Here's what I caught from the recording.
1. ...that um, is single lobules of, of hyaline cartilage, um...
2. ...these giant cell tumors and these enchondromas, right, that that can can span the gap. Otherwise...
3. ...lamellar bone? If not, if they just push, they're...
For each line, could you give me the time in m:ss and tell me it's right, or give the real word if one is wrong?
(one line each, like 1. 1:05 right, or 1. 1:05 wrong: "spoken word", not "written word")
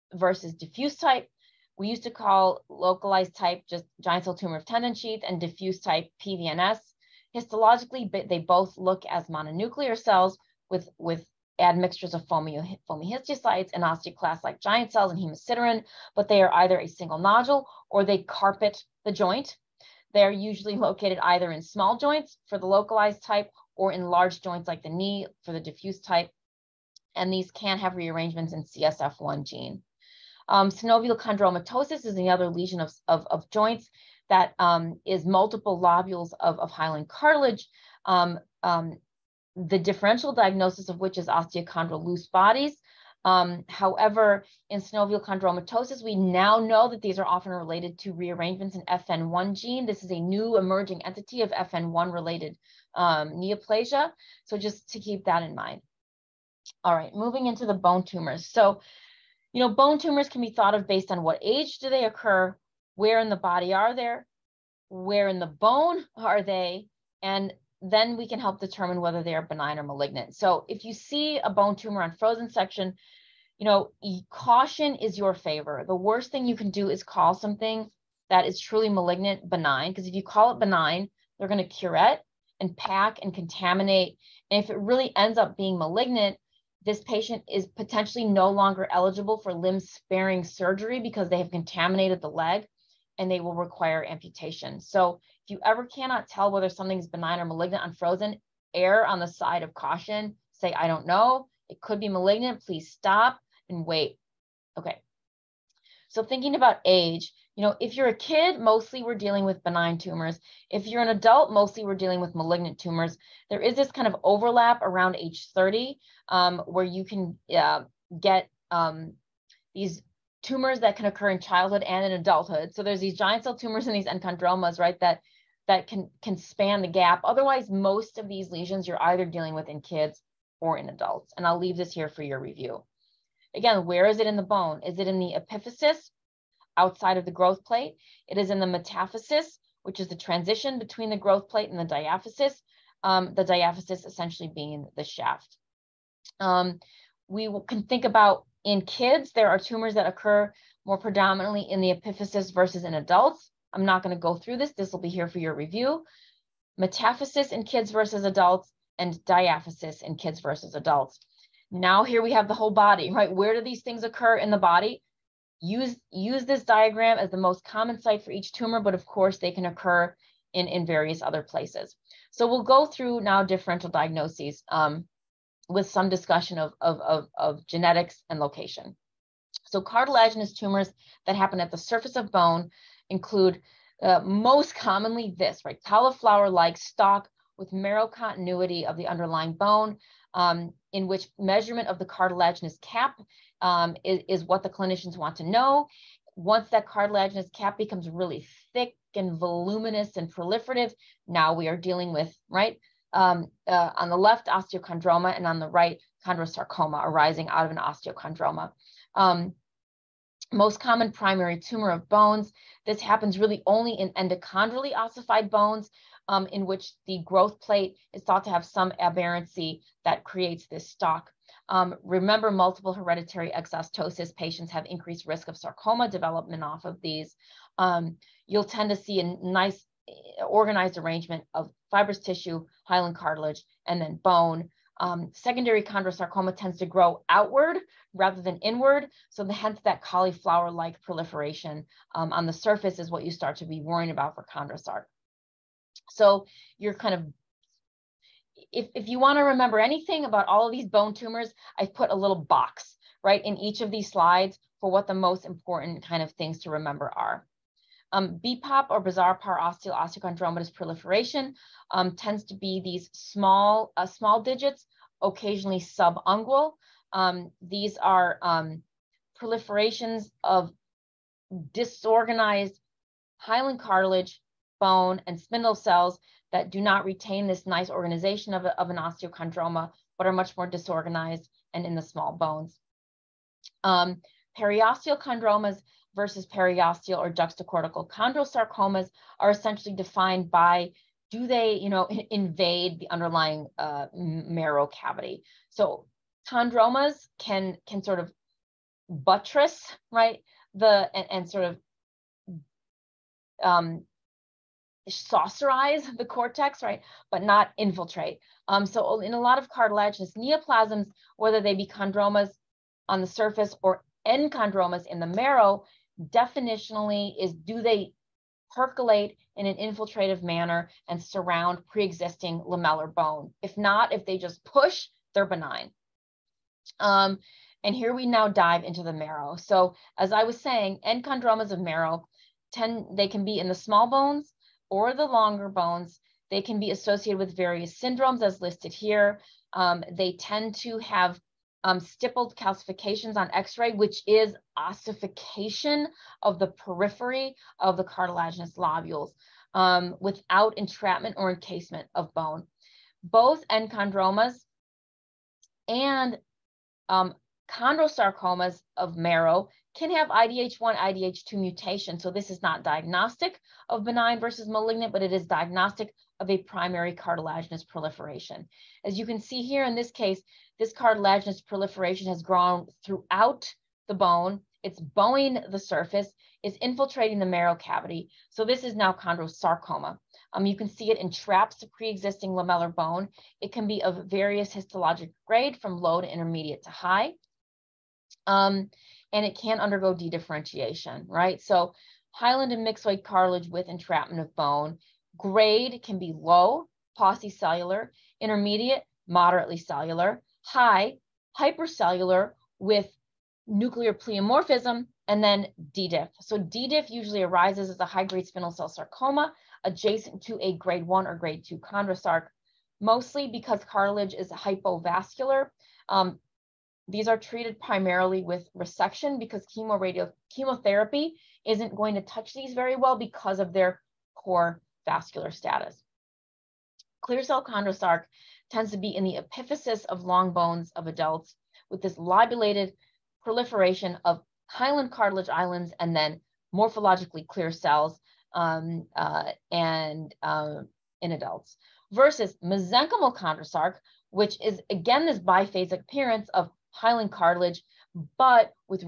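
1. 0:34 wrong: "multiple", not "single"
2. 2:02 right
3. 5:22 right.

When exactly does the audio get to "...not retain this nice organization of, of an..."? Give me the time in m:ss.
4:36.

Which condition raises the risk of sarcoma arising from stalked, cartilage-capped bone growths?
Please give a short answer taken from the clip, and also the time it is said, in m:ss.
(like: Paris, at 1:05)
Multiple hereditary exostosis, at 3:42.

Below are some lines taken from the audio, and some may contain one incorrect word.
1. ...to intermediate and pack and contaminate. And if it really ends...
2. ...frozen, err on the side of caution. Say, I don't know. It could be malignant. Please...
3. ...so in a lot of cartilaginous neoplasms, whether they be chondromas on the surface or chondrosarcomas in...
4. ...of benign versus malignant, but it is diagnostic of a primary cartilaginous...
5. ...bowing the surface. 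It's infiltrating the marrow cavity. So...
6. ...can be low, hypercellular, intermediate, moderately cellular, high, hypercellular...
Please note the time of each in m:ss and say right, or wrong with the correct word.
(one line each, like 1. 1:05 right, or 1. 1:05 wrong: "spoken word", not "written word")
1. 1:21 wrong: "curette", not "intermediate"
2. 1:37 right
3. 5:08 wrong: "enchondromas", not "chondrosarcomas"
4. 6:03 right
5. 6:14 right
6. 6:36 wrong: "cellular", not "hypercellular".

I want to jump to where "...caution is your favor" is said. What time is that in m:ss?
1:14.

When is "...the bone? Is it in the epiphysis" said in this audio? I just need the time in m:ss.
2:14.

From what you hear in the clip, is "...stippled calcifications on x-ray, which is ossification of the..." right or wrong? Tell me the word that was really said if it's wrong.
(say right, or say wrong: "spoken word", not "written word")
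right.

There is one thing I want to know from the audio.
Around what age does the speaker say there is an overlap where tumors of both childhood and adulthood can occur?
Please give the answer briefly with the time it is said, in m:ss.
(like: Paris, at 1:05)
30, at 1:55.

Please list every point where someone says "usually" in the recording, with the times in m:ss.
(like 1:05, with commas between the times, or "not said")
0:20, 6:47.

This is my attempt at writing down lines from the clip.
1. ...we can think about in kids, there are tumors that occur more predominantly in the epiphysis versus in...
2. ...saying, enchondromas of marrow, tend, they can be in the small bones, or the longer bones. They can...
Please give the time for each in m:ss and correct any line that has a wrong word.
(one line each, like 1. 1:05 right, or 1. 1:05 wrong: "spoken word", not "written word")
1. 2:27 right
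2. 5:30 right.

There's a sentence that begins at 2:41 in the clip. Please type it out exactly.
Now here we have the whole body, right?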